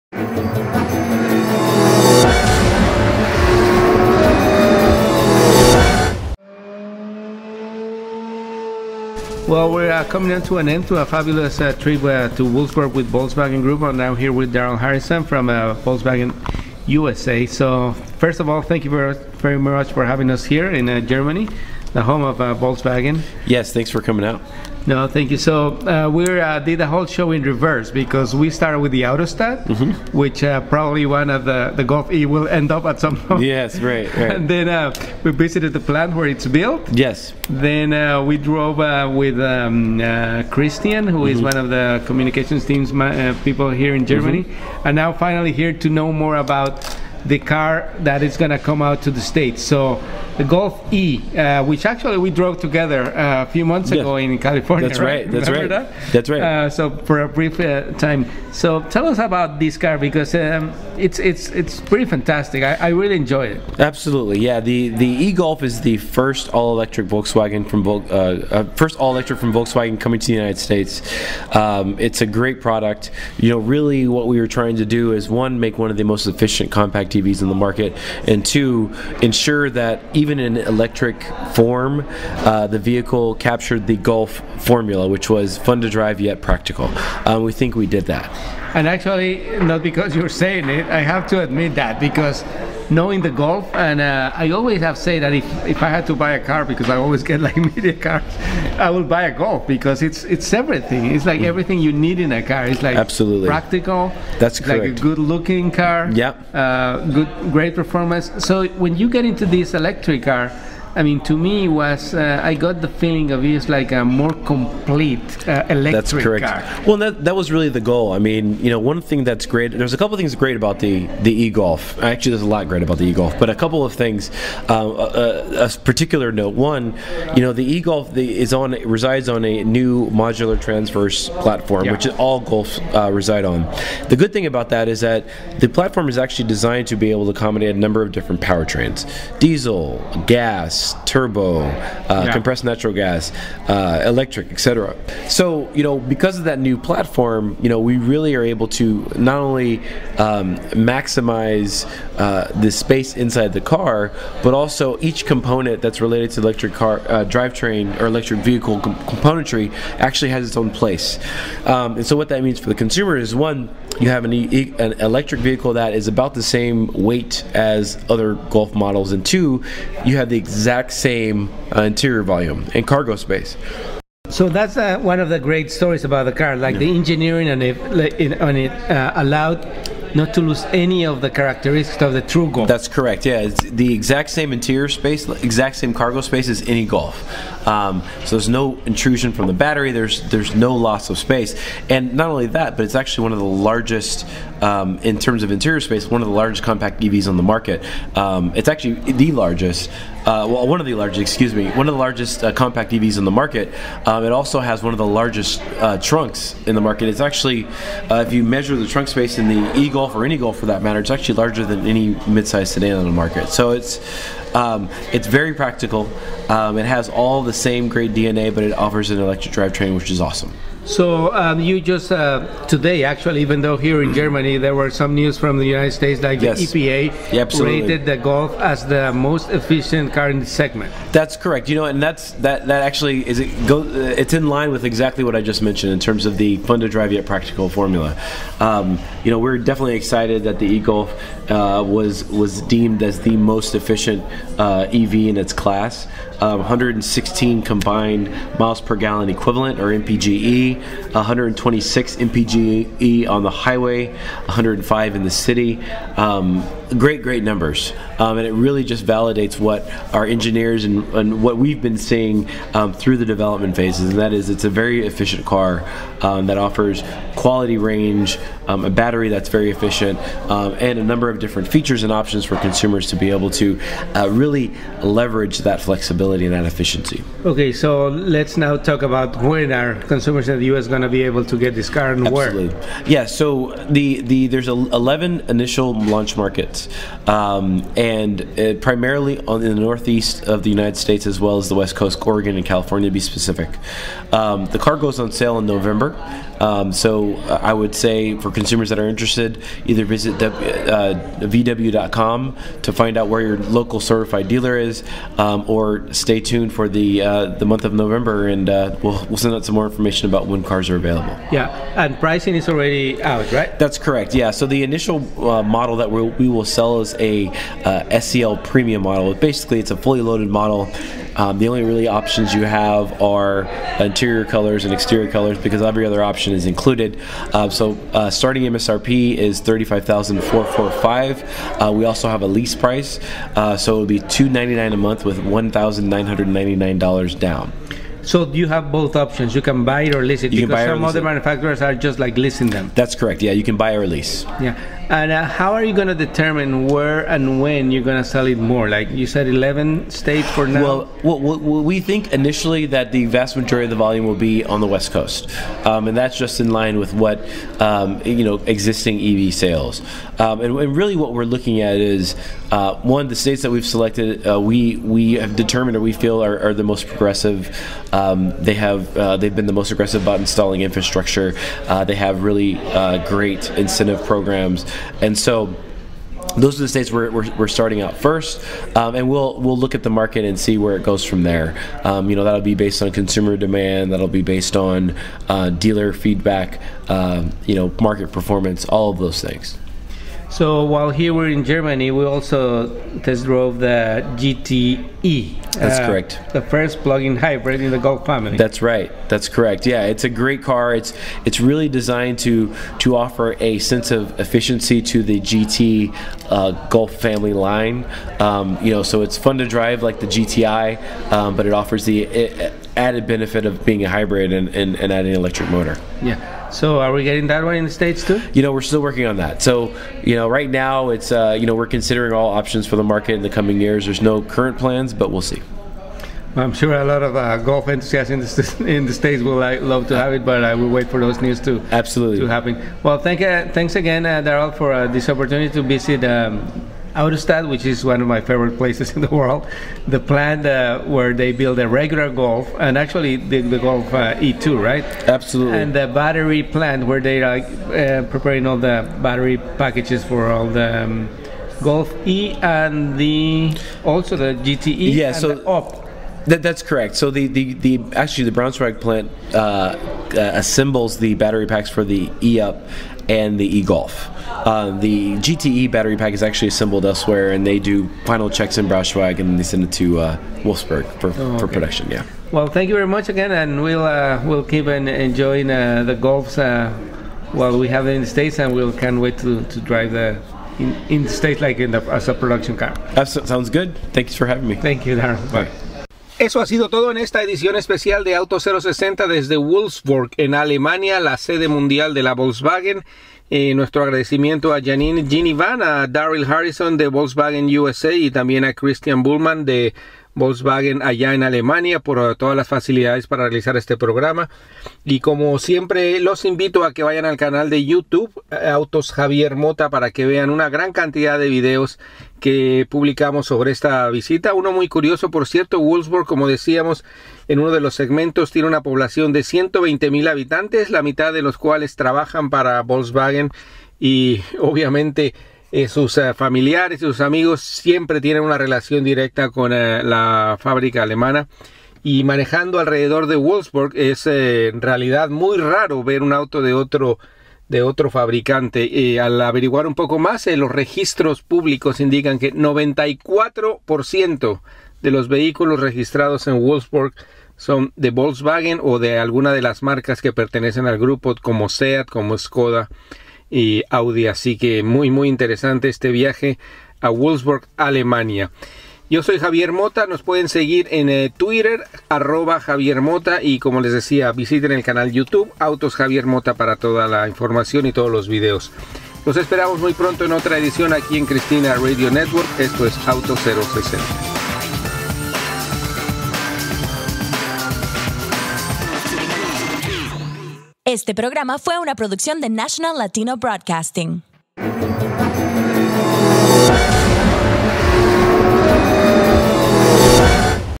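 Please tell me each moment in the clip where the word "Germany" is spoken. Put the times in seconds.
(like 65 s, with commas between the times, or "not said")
21 s, 44 s, 224 s, 391 s.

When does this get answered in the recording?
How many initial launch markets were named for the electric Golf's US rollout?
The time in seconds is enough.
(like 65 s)
284 s.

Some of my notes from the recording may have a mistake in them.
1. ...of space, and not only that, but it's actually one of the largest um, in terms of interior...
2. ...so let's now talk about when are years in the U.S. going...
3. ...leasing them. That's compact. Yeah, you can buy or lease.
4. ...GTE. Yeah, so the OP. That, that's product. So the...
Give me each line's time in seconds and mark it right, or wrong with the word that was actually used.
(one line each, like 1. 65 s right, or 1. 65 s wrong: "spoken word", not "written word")
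1. 191 s right
2. 277 s wrong: "consumers", not "years"
3. 342 s wrong: "correct", not "compact"
4. 454 s wrong: "correct", not "product".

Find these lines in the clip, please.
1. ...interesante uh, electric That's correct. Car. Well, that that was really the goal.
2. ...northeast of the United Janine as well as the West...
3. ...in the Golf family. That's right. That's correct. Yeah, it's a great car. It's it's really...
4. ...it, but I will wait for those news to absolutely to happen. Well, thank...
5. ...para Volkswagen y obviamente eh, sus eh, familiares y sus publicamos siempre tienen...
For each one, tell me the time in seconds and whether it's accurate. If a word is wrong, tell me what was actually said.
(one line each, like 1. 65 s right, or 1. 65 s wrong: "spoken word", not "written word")
1. 114 s wrong: "complete", not "interesante"
2. 289 s wrong: "States", not "Janine"
3. 397 s right
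4. 430 s right
5. 522 s wrong: "amigos", not "publicamos".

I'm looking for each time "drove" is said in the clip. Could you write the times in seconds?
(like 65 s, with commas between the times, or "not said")
38 s, 52 s, 393 s.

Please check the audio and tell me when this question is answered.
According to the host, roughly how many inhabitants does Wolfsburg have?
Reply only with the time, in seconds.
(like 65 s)
519 s.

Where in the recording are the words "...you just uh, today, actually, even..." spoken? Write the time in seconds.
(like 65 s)
221 s.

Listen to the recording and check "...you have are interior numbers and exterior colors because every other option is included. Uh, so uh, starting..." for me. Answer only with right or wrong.
wrong.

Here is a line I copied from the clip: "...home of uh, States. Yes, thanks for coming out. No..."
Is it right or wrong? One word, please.
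wrong.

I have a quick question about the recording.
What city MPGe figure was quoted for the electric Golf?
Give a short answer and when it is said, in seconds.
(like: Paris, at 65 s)
105, at 254 s.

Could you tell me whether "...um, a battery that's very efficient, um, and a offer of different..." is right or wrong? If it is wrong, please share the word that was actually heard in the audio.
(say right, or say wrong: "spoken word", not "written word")
wrong: "number", not "offer".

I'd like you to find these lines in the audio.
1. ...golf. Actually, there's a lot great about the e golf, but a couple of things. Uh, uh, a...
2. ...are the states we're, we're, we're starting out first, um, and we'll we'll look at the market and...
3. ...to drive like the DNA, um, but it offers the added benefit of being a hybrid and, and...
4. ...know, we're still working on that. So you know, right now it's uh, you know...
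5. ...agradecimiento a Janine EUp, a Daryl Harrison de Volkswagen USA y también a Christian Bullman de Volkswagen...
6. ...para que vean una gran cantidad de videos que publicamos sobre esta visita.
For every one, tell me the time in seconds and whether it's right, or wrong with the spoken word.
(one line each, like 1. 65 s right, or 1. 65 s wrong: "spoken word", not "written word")
1. 121 s right
2. 376 s right
3. 409 s wrong: "GTI", not "DNA"
4. 418 s right
5. 494 s wrong: "Ginivan", not "EUp"
6. 509 s right.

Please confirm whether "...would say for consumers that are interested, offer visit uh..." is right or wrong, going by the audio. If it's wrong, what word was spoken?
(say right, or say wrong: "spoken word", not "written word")
wrong: "either", not "offer".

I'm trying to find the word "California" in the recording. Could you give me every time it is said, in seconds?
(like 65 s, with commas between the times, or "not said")
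54 s, 292 s.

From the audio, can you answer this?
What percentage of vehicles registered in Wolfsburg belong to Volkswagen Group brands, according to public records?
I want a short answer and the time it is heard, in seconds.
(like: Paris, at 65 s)
94%, at 542 s.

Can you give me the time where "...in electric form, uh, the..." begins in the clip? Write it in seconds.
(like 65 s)
80 s.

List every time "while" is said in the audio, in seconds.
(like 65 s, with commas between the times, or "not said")
390 s, 477 s.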